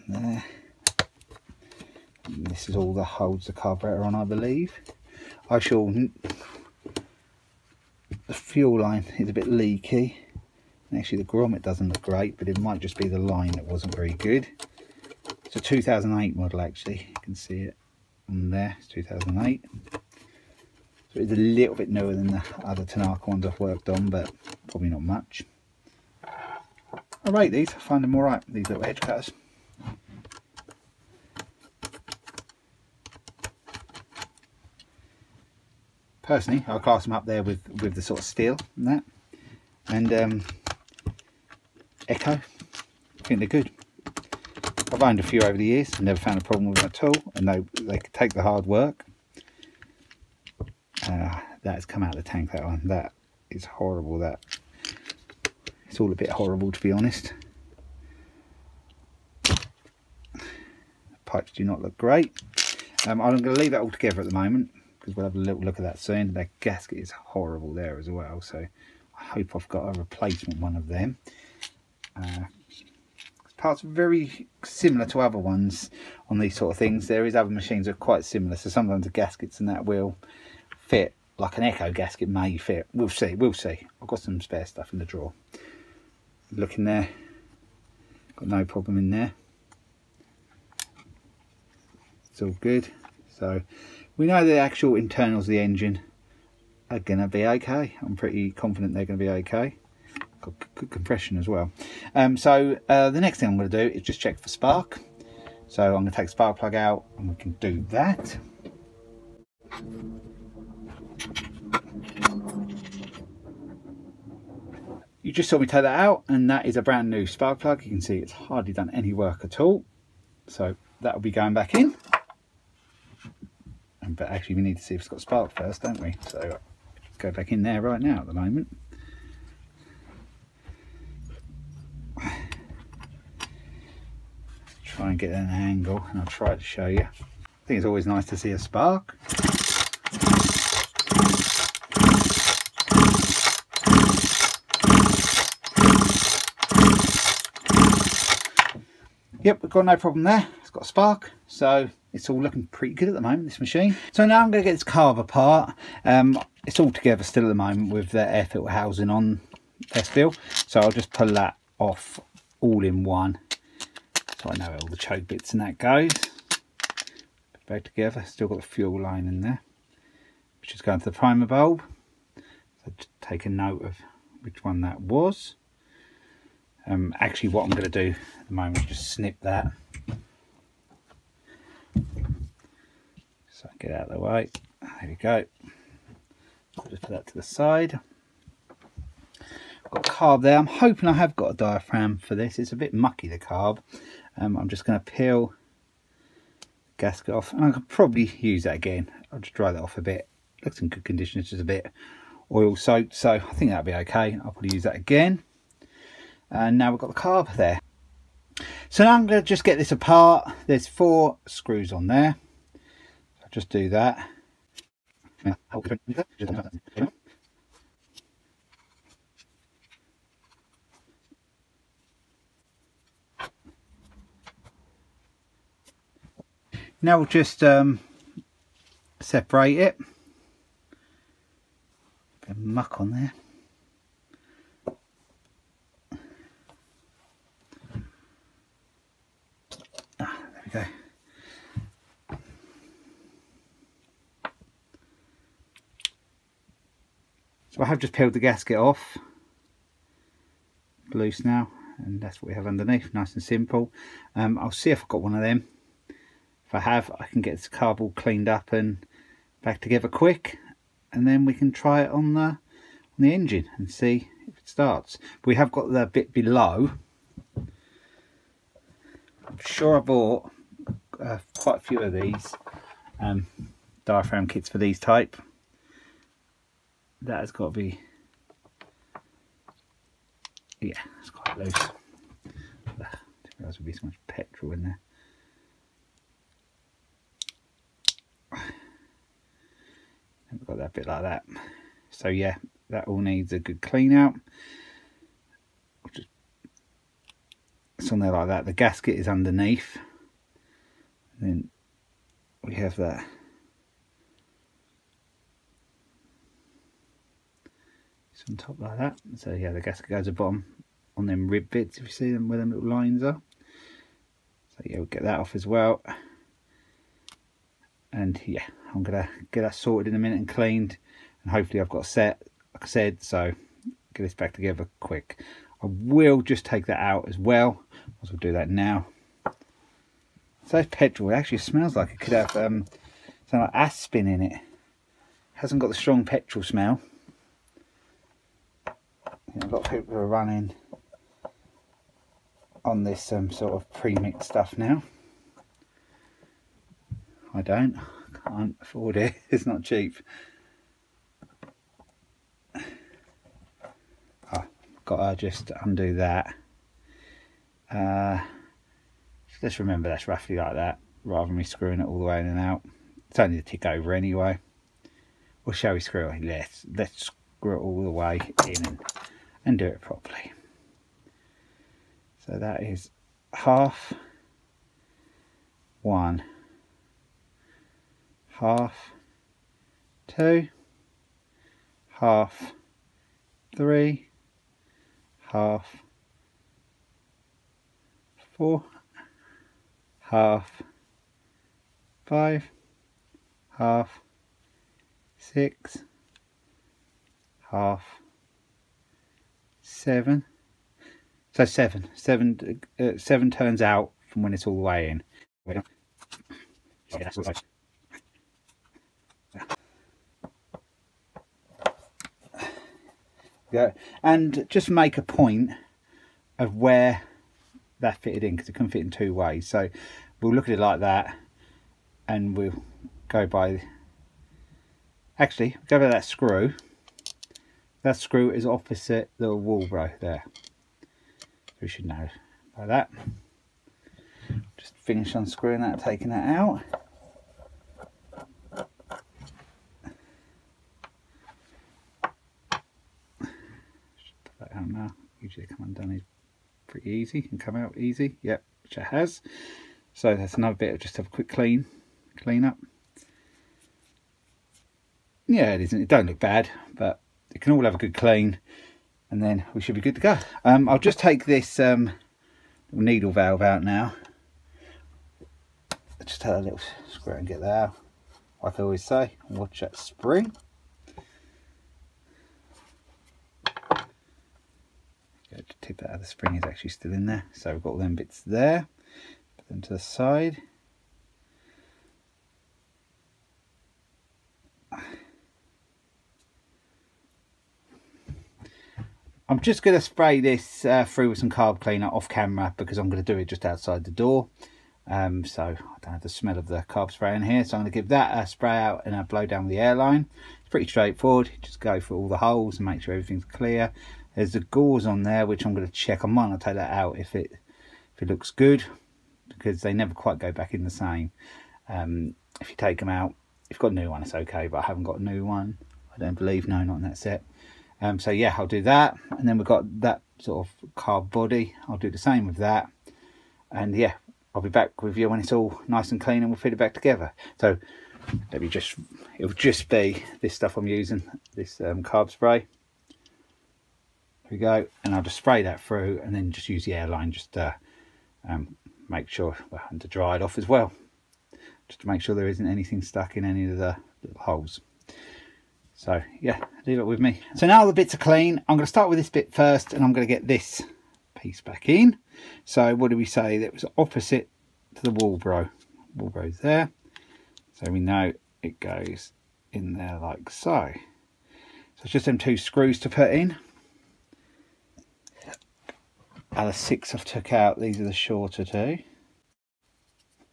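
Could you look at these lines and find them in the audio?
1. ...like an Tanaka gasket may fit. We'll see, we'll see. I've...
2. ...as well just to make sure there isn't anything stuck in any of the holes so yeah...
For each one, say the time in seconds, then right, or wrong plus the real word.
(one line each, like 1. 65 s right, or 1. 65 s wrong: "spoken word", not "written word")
1. 81 s wrong: "Echo", not "Tanaka"
2. 540 s right.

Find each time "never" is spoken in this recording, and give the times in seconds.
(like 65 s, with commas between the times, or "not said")
46 s, 509 s.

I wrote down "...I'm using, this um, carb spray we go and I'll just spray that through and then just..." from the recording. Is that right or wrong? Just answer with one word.
right.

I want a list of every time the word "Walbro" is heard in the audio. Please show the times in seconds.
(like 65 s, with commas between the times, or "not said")
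429 s, 555 s.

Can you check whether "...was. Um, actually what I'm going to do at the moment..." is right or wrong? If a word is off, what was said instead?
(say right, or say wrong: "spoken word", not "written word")
right.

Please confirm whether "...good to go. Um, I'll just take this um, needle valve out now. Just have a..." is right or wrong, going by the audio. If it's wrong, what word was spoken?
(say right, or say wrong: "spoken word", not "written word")
right.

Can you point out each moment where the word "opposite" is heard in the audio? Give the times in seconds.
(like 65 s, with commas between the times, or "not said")
428 s, 553 s.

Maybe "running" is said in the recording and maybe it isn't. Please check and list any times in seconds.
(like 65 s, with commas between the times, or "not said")
340 s.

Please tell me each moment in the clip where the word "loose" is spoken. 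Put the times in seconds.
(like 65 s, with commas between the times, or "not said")
251 s, 281 s.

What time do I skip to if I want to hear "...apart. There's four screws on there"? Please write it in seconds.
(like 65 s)
209 s.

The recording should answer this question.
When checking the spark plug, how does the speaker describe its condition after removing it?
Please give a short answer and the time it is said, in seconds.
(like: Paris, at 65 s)
brand new, at 116 s.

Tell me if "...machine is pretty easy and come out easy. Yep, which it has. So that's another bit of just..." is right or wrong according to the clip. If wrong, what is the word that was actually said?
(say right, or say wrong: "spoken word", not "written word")
wrong: "undone", not "machine".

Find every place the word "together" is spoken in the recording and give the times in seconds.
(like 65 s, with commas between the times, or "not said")
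63 s, 156 s, 167 s, 259 s, 324 s, 526 s.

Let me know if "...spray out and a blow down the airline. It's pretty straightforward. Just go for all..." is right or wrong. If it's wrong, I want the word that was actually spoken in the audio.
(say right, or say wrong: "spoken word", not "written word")
right.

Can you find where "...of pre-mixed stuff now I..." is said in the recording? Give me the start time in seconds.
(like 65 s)
343 s.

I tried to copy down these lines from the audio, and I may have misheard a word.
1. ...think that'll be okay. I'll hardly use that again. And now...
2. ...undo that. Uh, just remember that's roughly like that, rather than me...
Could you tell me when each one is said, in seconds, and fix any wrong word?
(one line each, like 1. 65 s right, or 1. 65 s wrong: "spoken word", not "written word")
1. 203 s wrong: "probably", not "hardly"
2. 355 s right.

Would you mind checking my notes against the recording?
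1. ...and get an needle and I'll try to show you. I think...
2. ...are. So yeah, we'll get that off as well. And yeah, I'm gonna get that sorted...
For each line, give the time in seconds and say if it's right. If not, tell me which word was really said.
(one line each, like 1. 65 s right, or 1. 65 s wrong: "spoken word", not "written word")
1. 135 s wrong: "angle", not "needle"
2. 313 s right.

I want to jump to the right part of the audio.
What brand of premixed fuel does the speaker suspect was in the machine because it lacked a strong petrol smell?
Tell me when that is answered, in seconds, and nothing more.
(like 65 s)
333 s.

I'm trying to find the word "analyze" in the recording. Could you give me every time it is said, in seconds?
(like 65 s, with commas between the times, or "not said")
not said.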